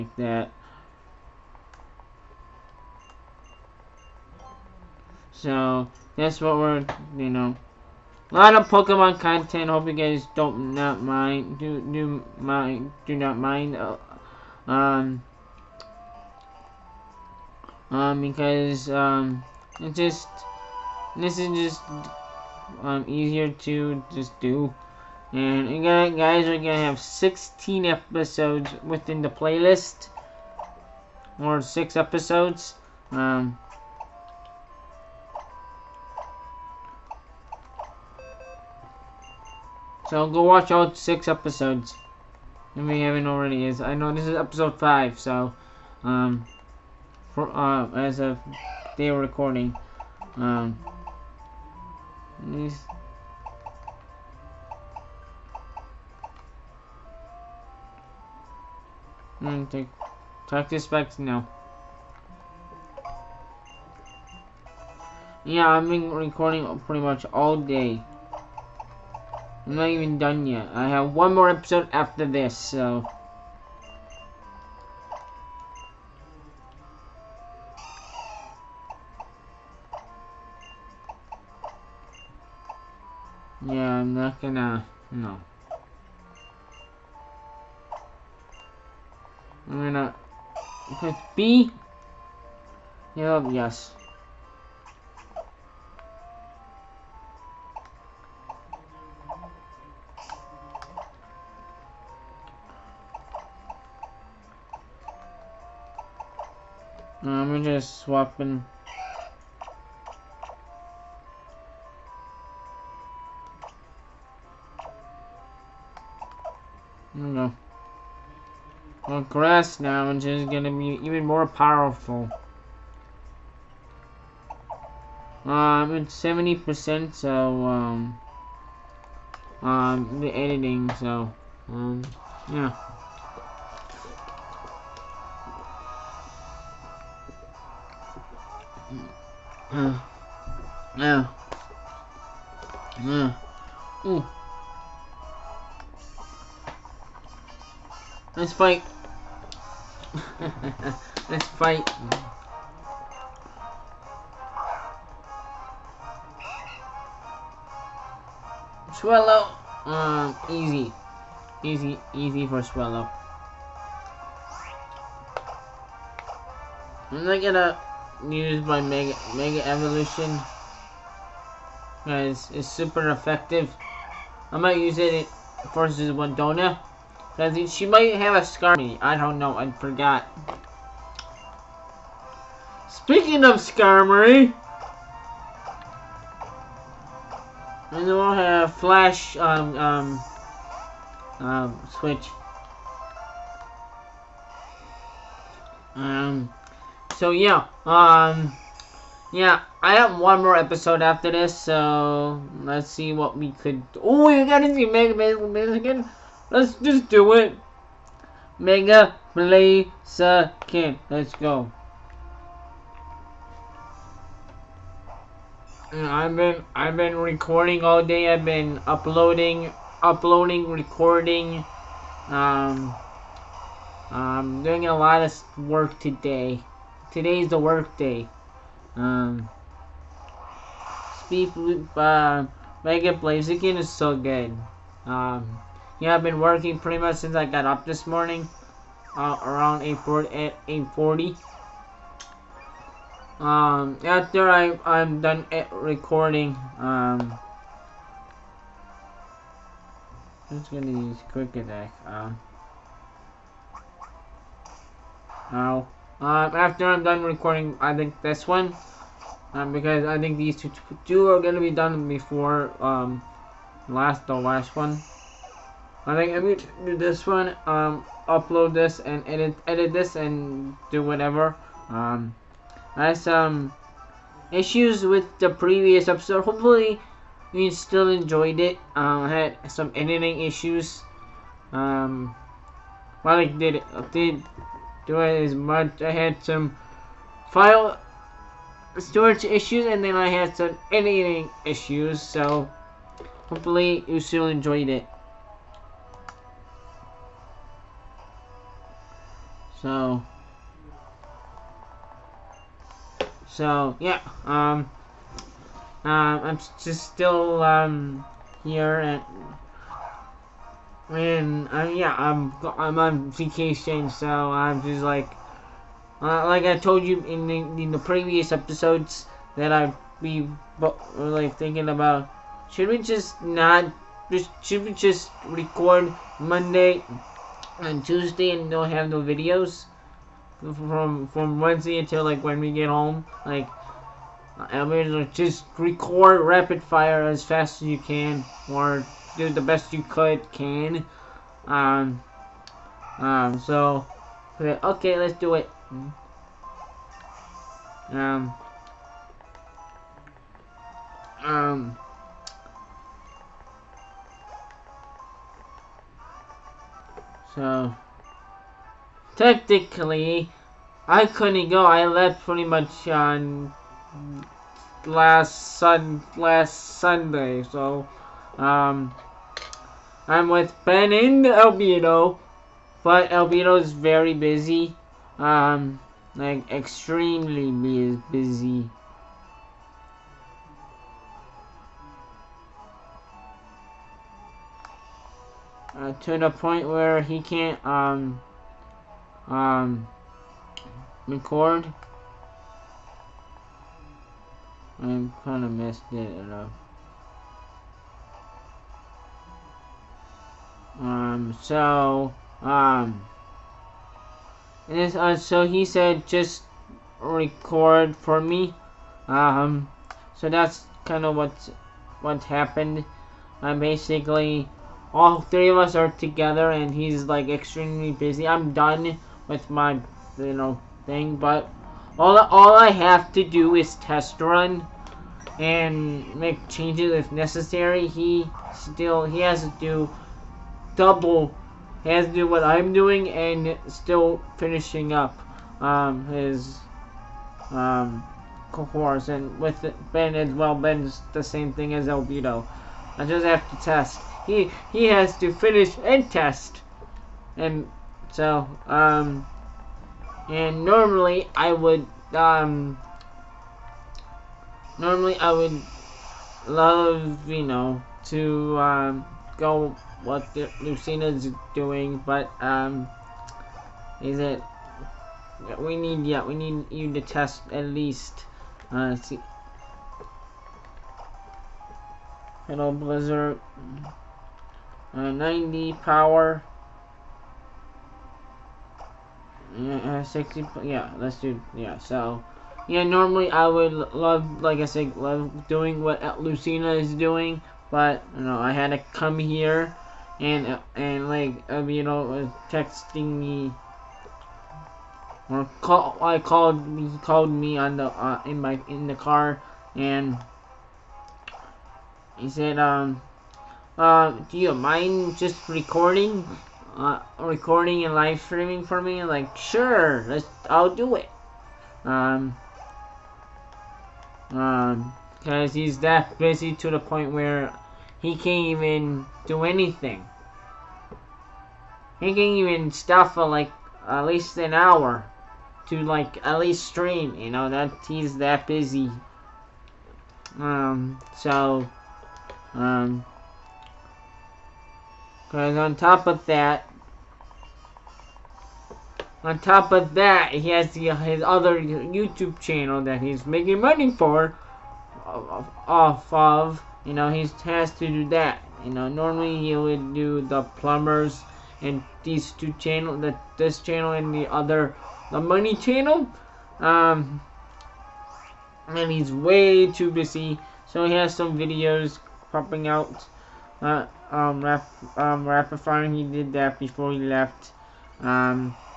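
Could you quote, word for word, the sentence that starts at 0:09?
Hope you guys don't not mind do do mind do not mind.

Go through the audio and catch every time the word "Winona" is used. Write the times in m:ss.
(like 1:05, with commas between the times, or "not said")
2:56.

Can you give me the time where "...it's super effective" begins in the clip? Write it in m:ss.
2:52.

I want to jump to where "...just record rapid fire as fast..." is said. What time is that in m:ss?
5:35.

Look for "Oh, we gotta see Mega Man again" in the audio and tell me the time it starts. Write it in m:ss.
3:24.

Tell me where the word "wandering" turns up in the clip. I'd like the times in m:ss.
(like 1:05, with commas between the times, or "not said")
not said.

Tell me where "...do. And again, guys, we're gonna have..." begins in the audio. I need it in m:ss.
0:24.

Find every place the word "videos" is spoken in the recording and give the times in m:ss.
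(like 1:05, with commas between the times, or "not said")
5:29, 9:21.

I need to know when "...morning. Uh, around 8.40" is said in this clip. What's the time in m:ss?
3:58.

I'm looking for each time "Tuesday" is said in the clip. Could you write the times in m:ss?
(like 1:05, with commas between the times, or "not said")
5:28.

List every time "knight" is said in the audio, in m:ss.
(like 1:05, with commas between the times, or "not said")
not said.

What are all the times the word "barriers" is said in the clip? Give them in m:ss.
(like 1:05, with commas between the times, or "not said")
not said.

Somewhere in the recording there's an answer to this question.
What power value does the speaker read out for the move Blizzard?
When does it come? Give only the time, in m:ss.
7:55.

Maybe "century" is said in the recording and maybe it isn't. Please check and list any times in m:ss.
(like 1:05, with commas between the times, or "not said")
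not said.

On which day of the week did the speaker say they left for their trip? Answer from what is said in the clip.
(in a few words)
Sunday.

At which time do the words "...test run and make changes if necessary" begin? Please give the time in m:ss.
7:03.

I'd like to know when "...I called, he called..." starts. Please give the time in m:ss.
8:16.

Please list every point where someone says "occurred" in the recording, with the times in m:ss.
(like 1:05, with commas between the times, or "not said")
not said.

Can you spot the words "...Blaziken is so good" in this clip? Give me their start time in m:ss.
3:53.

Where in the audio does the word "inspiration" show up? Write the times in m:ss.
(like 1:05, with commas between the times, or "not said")
not said.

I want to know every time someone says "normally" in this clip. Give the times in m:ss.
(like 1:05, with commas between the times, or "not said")
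7:30, 7:34, 8:03, 9:09.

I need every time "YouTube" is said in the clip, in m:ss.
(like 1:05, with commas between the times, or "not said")
9:01.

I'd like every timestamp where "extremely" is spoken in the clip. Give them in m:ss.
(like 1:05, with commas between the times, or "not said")
6:16, 6:57.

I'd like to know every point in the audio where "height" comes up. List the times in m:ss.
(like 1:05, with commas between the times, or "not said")
not said.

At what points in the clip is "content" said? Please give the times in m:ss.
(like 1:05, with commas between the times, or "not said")
0:09.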